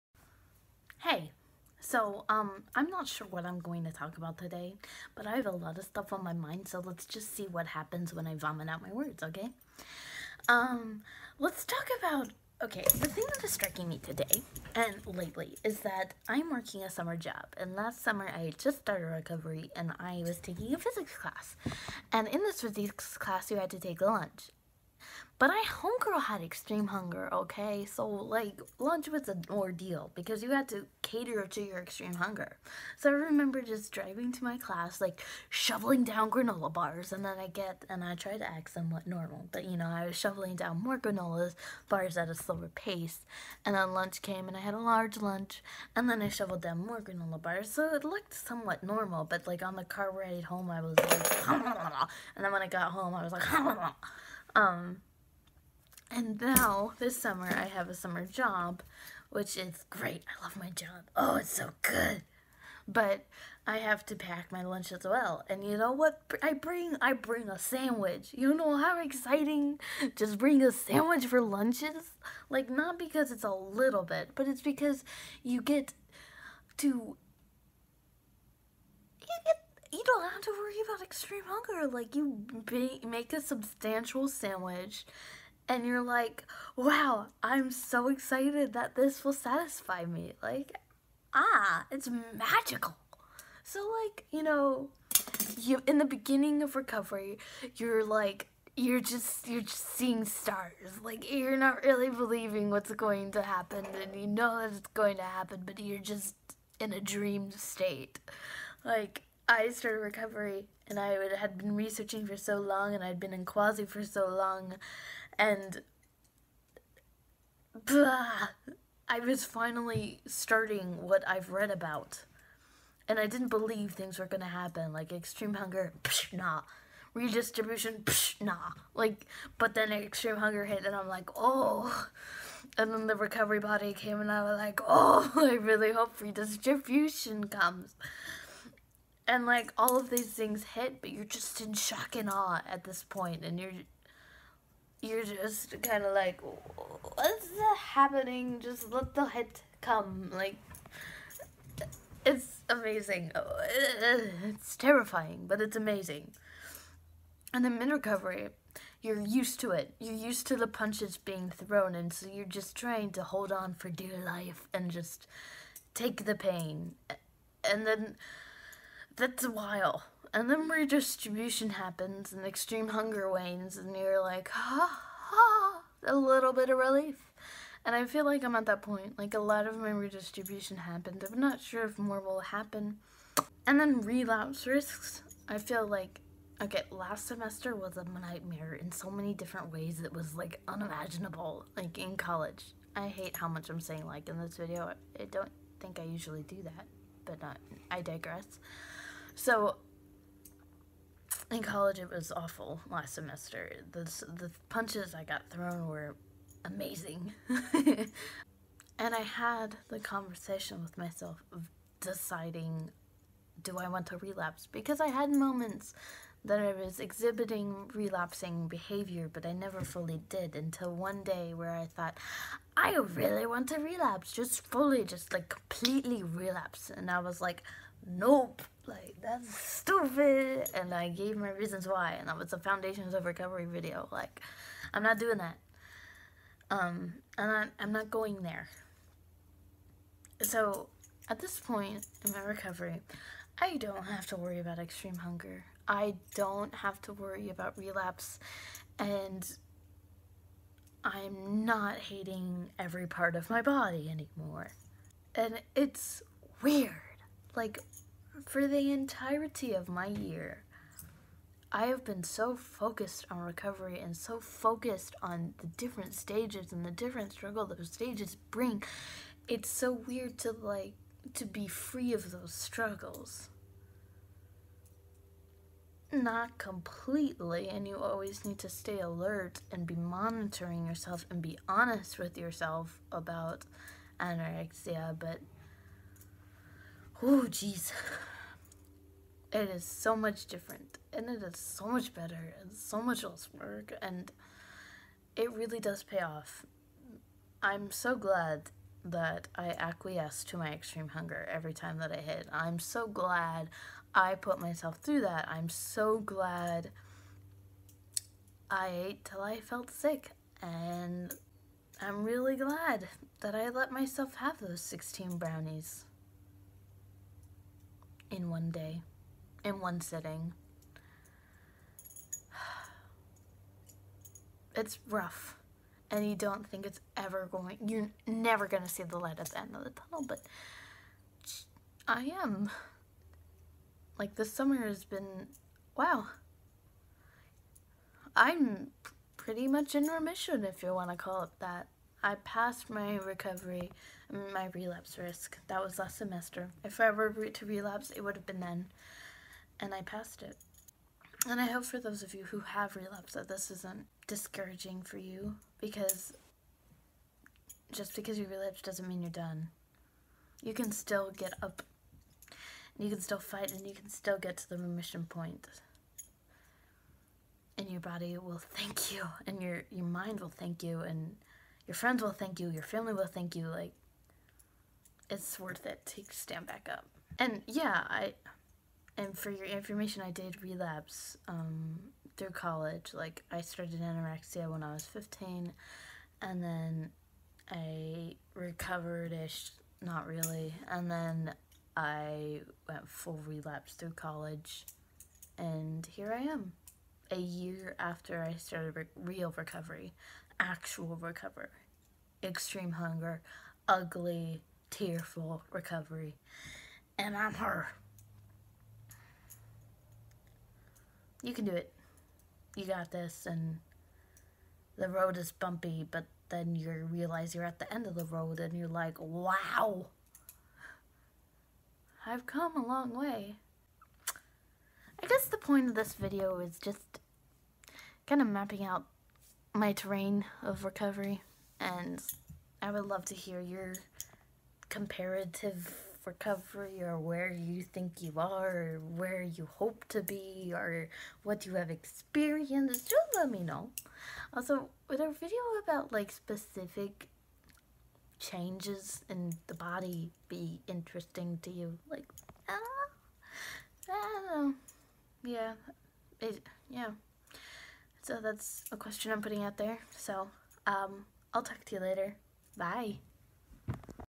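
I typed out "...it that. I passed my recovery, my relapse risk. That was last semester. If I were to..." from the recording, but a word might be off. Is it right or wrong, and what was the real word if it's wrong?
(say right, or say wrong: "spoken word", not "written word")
right.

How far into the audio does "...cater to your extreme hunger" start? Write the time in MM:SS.
00:31.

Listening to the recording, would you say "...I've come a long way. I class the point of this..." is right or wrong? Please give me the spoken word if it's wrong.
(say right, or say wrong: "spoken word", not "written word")
wrong: "guess", not "class".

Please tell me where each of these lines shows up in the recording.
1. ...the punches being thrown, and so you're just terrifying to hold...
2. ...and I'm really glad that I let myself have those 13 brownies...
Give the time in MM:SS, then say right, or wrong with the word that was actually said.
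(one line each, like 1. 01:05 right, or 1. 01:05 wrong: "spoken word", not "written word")
1. 02:40 wrong: "trying", not "terrifying"
2. 05:10 wrong: "16", not "13".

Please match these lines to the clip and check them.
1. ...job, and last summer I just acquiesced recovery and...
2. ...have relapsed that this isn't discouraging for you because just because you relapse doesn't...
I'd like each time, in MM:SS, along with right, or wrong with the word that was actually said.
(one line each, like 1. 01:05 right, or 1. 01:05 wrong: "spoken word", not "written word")
1. 00:17 wrong: "started", not "acquiesced"
2. 05:52 right.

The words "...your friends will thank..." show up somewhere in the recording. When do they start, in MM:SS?
06:11.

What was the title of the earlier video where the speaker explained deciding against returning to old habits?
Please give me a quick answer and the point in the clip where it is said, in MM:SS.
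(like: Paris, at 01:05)
Foundations of Recovery, at 03:52.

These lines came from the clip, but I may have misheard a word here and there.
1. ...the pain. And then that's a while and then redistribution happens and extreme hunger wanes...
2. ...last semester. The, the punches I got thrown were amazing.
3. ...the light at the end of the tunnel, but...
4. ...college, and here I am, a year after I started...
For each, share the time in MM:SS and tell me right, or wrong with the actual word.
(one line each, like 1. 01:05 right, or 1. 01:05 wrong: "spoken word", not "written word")
1. 02:46 right
2. 03:22 right
3. 05:29 right
4. 06:34 right.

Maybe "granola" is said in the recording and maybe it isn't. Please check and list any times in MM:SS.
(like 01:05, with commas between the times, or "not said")
00:36, 00:40, 00:47.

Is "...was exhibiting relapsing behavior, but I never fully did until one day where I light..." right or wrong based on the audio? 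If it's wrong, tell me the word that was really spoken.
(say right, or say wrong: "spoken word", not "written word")
wrong: "thought", not "light".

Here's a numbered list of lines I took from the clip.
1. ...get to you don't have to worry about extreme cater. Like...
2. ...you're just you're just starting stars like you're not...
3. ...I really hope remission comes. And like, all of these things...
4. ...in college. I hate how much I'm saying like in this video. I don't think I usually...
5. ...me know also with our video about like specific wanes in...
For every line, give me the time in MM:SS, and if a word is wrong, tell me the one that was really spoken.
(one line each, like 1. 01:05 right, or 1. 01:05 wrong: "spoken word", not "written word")
1. 01:15 wrong: "hunger", not "cater"
2. 01:38 wrong: "seeing", not "starting"
3. 02:15 wrong: "redistribution", not "remission"
4. 03:11 right
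5. 07:23 wrong: "changes", not "wanes".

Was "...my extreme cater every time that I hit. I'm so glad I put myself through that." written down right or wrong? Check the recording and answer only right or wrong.
wrong.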